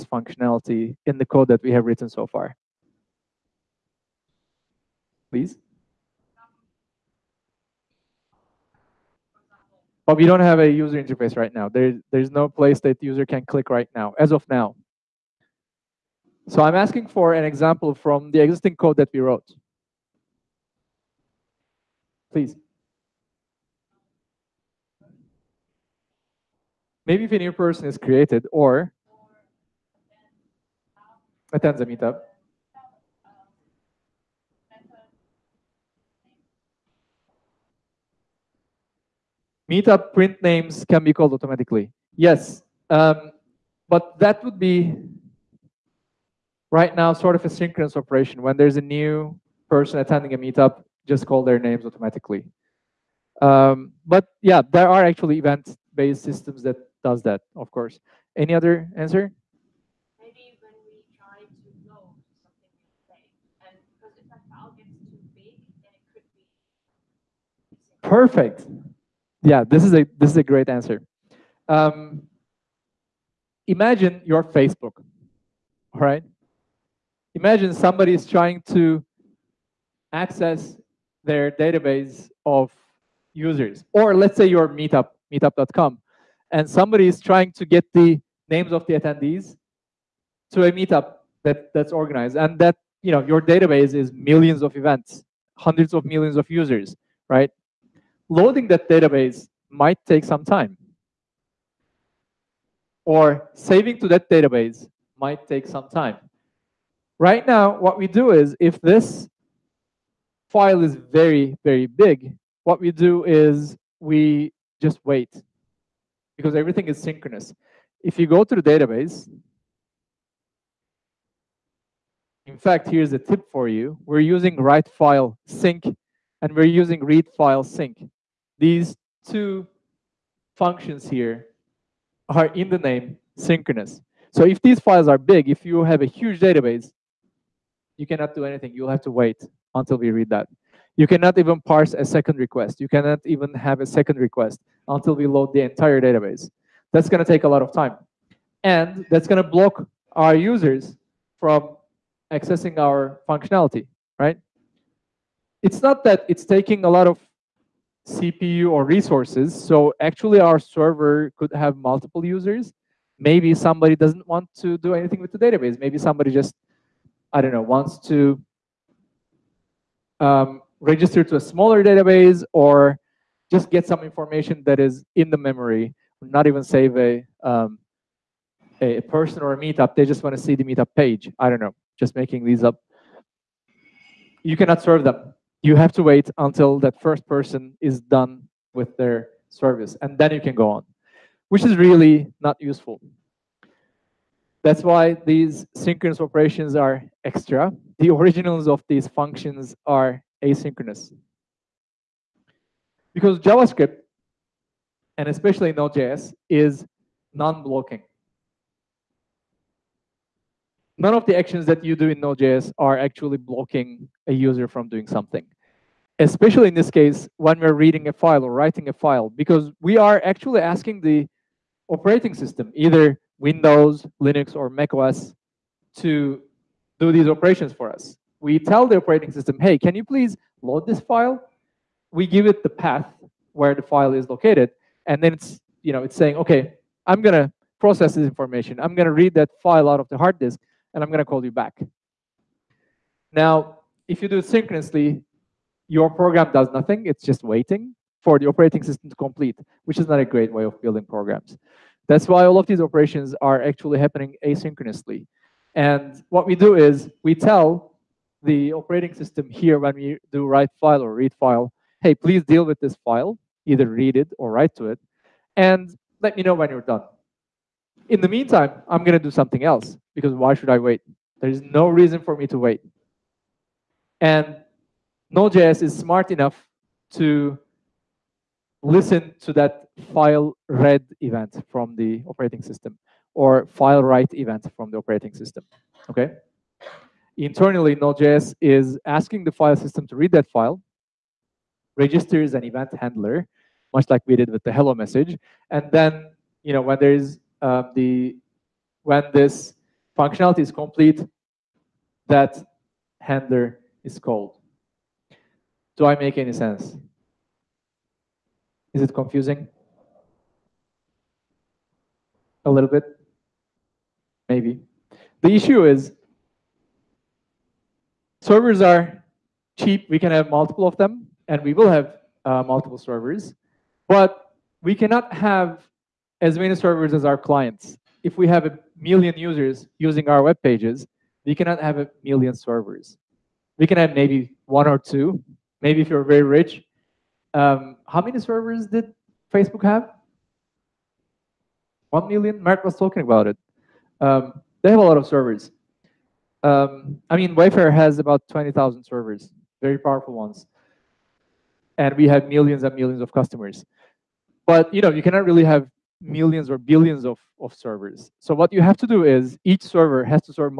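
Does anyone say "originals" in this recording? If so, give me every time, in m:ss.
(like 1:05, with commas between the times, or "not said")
3:18.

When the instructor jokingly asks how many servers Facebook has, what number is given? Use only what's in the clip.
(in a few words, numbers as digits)
1 million.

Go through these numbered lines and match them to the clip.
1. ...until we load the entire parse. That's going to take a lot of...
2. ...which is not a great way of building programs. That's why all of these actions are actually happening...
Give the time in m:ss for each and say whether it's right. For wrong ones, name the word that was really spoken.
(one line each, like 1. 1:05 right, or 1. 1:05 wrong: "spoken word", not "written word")
1. 2:24 wrong: "database", not "parse"
2. 4:09 wrong: "operations", not "actions".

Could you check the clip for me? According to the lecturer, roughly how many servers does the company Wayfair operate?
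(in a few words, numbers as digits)
20,000.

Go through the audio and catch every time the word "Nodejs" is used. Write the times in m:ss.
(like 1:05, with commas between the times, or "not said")
3:25, 3:32, 4:35, 4:47.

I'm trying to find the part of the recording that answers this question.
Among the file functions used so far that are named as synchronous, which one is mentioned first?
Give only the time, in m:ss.
2:04.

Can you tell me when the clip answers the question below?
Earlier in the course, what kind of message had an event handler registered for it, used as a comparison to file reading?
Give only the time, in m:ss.
4:54.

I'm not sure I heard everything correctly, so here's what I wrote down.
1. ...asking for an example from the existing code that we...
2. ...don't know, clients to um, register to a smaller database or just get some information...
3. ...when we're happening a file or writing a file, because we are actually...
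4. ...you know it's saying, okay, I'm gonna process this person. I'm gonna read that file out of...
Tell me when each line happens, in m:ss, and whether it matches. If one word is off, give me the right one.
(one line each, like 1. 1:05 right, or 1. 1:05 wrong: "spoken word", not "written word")
1. 0:16 right
2. 2:47 wrong: "wants", not "clients"
3. 3:37 wrong: "reading", not "happening"
4. 3:55 wrong: "information", not "person".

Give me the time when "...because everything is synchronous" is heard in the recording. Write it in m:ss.
1:56.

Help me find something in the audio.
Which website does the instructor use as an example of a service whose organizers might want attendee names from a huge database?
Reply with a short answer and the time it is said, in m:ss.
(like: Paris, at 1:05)
Meetup.com, at 1:25.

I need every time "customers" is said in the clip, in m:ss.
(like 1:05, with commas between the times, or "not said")
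5:53.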